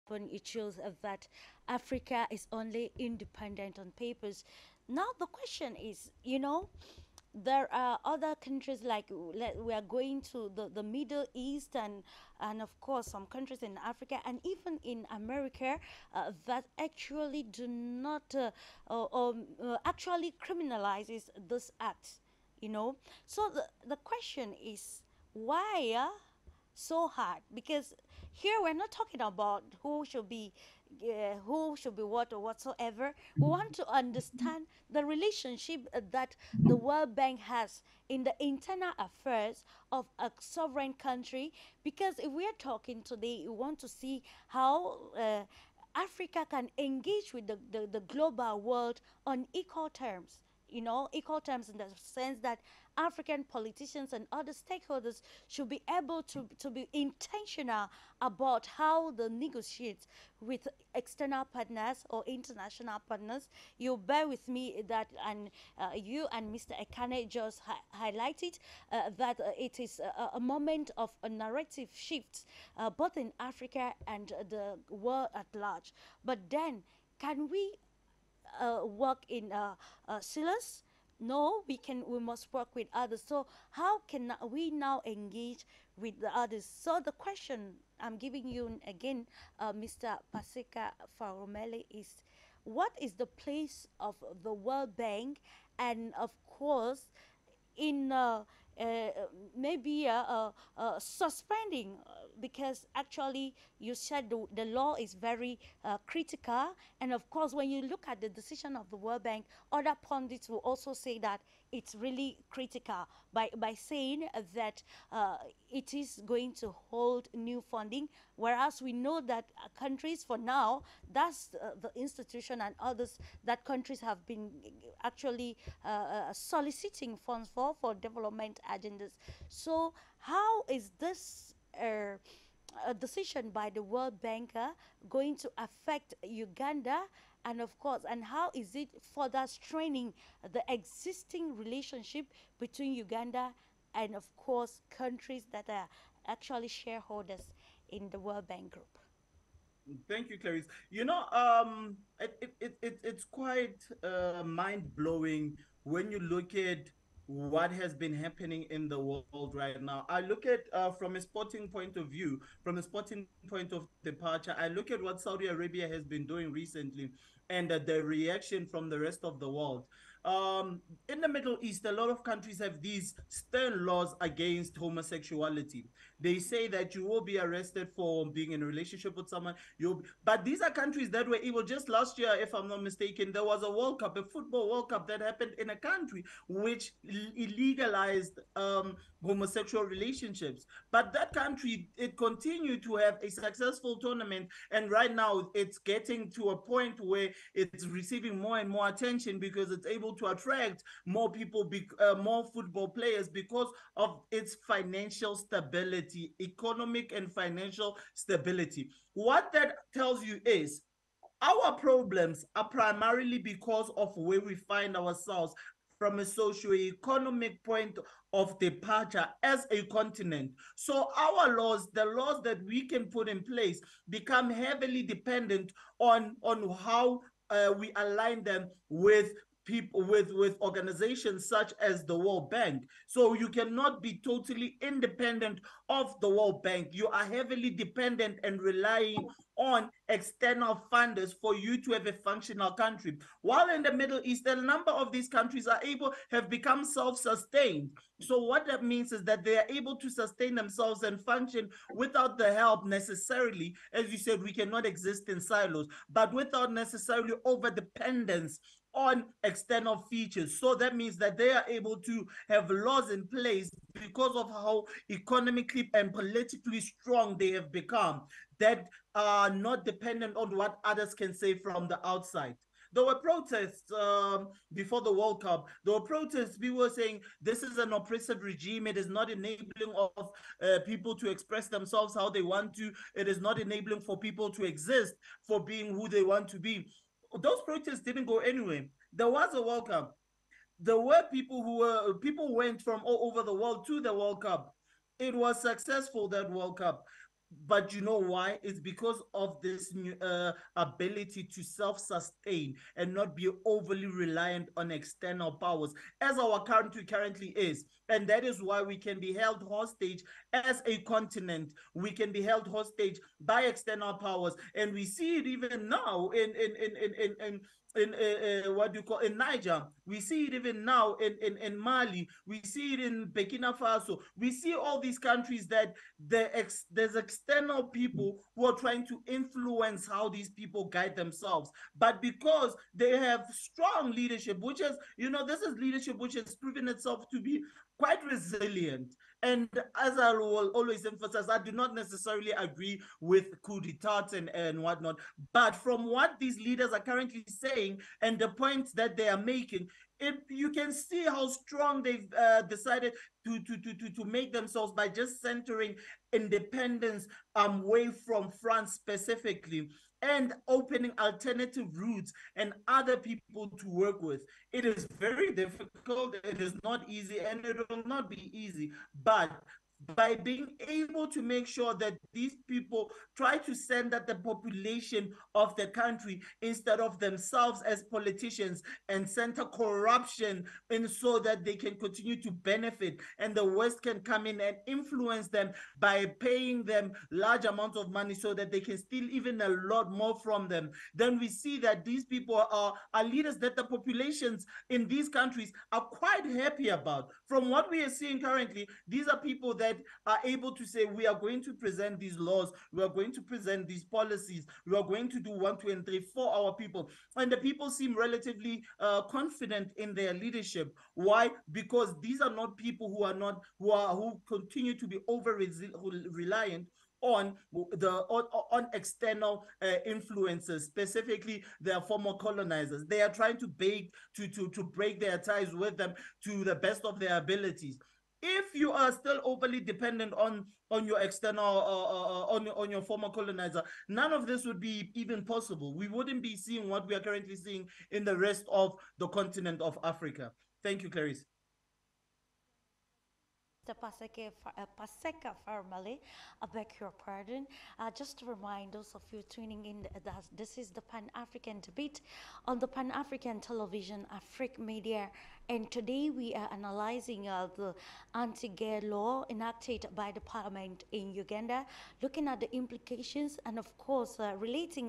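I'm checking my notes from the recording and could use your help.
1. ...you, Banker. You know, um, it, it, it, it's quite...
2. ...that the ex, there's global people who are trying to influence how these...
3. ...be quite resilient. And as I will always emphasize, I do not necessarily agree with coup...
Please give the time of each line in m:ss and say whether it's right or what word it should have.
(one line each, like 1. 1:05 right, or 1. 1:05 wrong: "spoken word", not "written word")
1. 2:30 wrong: "Clarice", not "Banker"
2. 5:25 wrong: "external", not "global"
3. 5:37 right.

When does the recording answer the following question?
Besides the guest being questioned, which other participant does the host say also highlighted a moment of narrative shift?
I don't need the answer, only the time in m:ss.
1:06.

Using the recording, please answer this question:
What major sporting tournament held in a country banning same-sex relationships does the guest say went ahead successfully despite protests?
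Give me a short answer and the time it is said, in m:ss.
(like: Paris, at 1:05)
football World Cup, at 3:04.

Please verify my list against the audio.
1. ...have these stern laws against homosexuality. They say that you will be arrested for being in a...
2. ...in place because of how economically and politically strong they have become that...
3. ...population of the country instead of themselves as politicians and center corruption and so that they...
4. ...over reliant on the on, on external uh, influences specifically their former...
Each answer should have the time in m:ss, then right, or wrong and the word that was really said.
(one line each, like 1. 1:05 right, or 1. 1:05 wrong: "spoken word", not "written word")
1. 2:52 right
2. 4:23 right
3. 6:14 right
4. 6:55 right.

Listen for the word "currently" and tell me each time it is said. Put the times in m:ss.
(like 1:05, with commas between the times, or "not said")
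5:07, 5:46, 6:38, 7:17.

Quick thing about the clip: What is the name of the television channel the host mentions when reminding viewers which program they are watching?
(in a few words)
Afrique Media.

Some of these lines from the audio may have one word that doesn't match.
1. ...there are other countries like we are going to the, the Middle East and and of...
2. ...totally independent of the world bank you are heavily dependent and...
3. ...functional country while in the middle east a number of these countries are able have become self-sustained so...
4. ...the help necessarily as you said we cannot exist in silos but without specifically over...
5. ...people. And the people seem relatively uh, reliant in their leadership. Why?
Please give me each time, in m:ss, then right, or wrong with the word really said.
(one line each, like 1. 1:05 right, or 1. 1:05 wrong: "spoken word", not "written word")
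1. 0:07 right
2. 3:54 right
3. 4:02 right
4. 4:12 wrong: "necessarily", not "specifically"
5. 6:46 wrong: "confident", not "reliant".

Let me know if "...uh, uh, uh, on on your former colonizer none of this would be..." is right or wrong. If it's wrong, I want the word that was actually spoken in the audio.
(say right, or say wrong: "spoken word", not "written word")
right.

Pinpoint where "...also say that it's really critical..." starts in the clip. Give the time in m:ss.
1:50.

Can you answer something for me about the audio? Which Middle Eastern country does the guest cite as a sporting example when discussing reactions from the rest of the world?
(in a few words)
Saudi Arabia.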